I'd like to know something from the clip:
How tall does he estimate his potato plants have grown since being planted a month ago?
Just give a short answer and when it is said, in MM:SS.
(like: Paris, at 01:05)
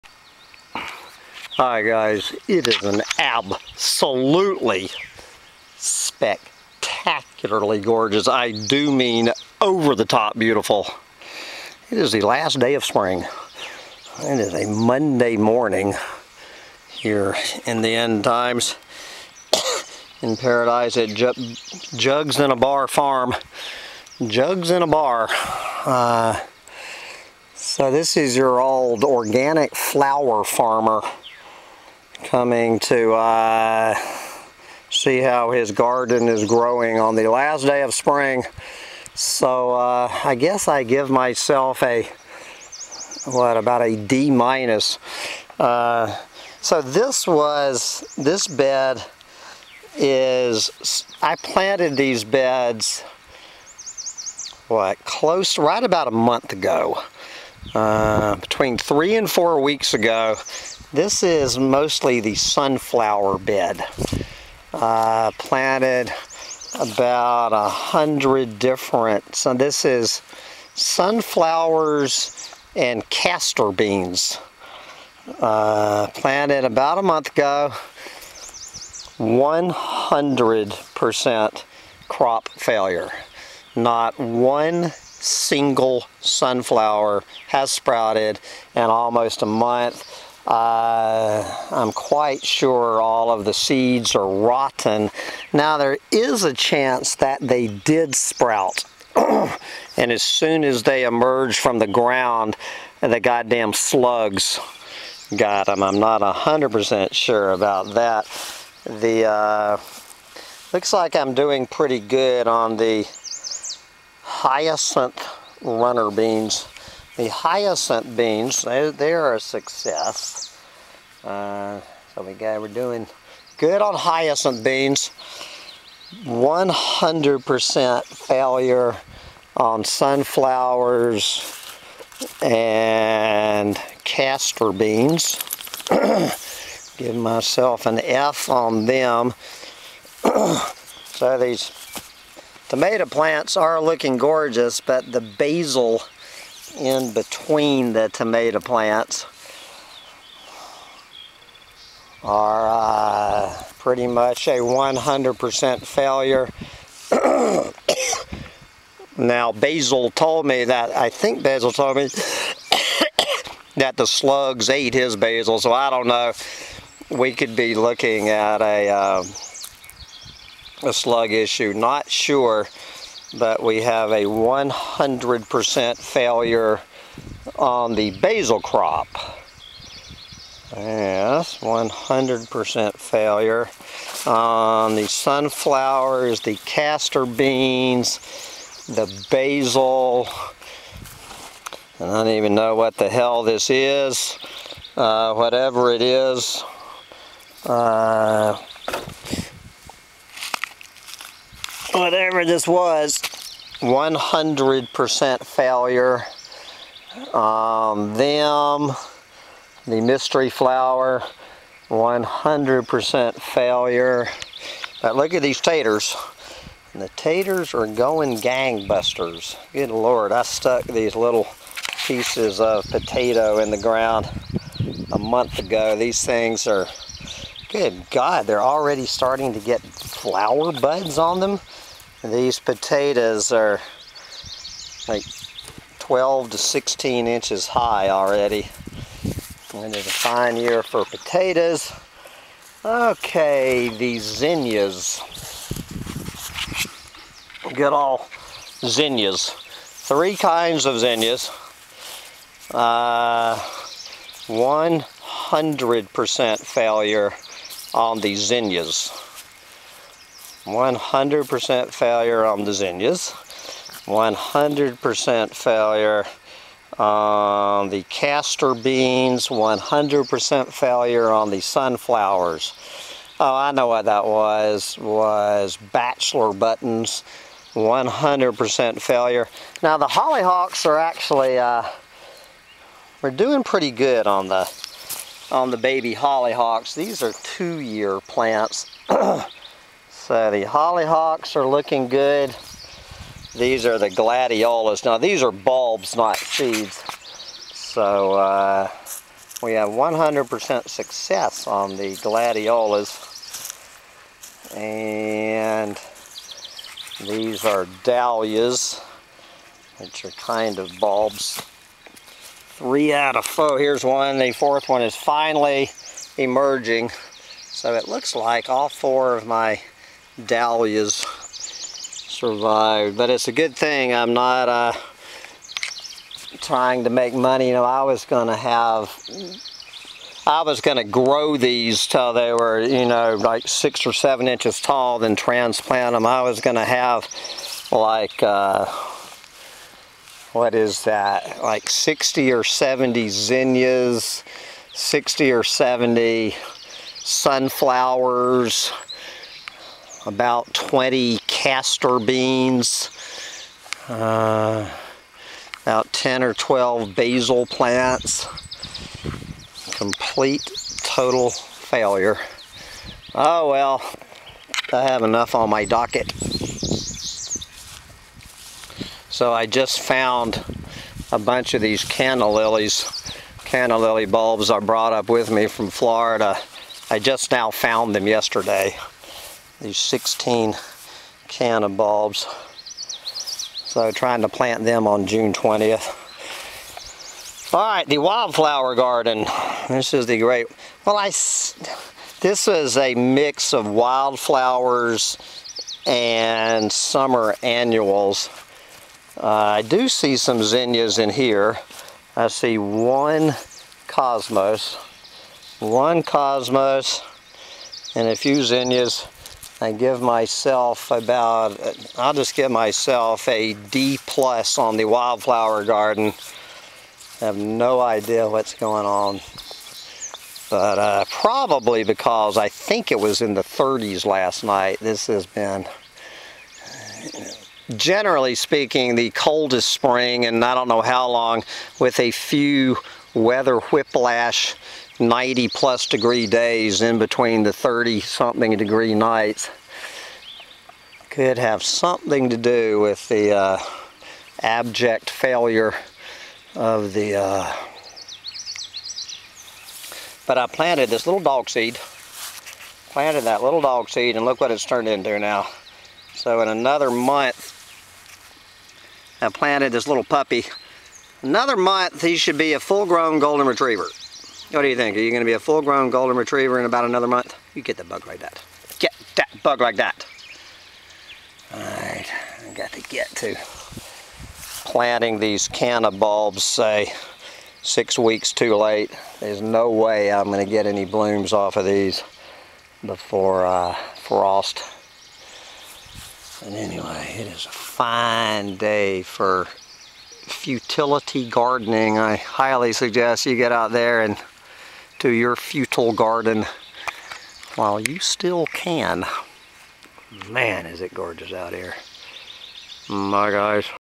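12 to 16 inches, at 03:55.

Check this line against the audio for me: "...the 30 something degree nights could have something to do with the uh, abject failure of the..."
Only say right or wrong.
right.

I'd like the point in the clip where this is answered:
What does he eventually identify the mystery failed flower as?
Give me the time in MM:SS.
04:35.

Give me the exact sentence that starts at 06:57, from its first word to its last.
I have no idea what's going on.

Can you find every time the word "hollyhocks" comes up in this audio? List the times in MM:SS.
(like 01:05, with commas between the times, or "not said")
04:40, 04:46, 04:50.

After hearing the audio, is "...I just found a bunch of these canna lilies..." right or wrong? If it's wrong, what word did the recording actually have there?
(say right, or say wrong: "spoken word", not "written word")
right.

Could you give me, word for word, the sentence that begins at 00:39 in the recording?
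So uh, I guess I give myself a, what, about a D minus.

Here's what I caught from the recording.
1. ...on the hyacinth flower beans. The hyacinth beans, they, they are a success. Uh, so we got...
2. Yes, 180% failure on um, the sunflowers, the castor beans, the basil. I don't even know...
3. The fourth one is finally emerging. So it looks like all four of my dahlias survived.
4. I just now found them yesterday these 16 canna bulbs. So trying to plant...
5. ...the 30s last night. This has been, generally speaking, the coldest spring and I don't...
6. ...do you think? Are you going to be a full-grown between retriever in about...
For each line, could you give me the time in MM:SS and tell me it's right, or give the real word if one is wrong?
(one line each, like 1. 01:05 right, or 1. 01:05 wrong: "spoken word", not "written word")
1. 01:52 wrong: "runner", not "flower"
2. 03:00 wrong: "100", not "180"
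3. 05:14 right
4. 06:17 right
5. 07:03 right
6. 07:44 wrong: "golden", not "between".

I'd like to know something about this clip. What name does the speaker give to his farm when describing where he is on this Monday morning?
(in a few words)
Jugs in a Bar Farm.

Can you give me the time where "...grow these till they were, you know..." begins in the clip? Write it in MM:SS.
05:31.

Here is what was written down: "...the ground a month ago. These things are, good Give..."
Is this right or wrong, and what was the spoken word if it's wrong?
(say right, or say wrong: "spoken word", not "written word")
wrong: "God", not "Give".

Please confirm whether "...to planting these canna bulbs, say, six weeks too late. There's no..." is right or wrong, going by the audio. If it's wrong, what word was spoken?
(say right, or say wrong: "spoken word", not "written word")
right.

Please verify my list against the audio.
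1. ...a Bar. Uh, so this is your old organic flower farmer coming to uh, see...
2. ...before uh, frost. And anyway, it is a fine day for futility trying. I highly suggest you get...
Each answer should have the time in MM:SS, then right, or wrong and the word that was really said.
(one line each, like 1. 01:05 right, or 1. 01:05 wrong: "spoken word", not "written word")
1. 00:24 right
2. 08:03 wrong: "gardening", not "trying".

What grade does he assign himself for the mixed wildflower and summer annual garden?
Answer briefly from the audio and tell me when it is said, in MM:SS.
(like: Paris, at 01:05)
D plus, at 06:53.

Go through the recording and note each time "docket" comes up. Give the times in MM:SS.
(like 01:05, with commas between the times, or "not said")
06:05.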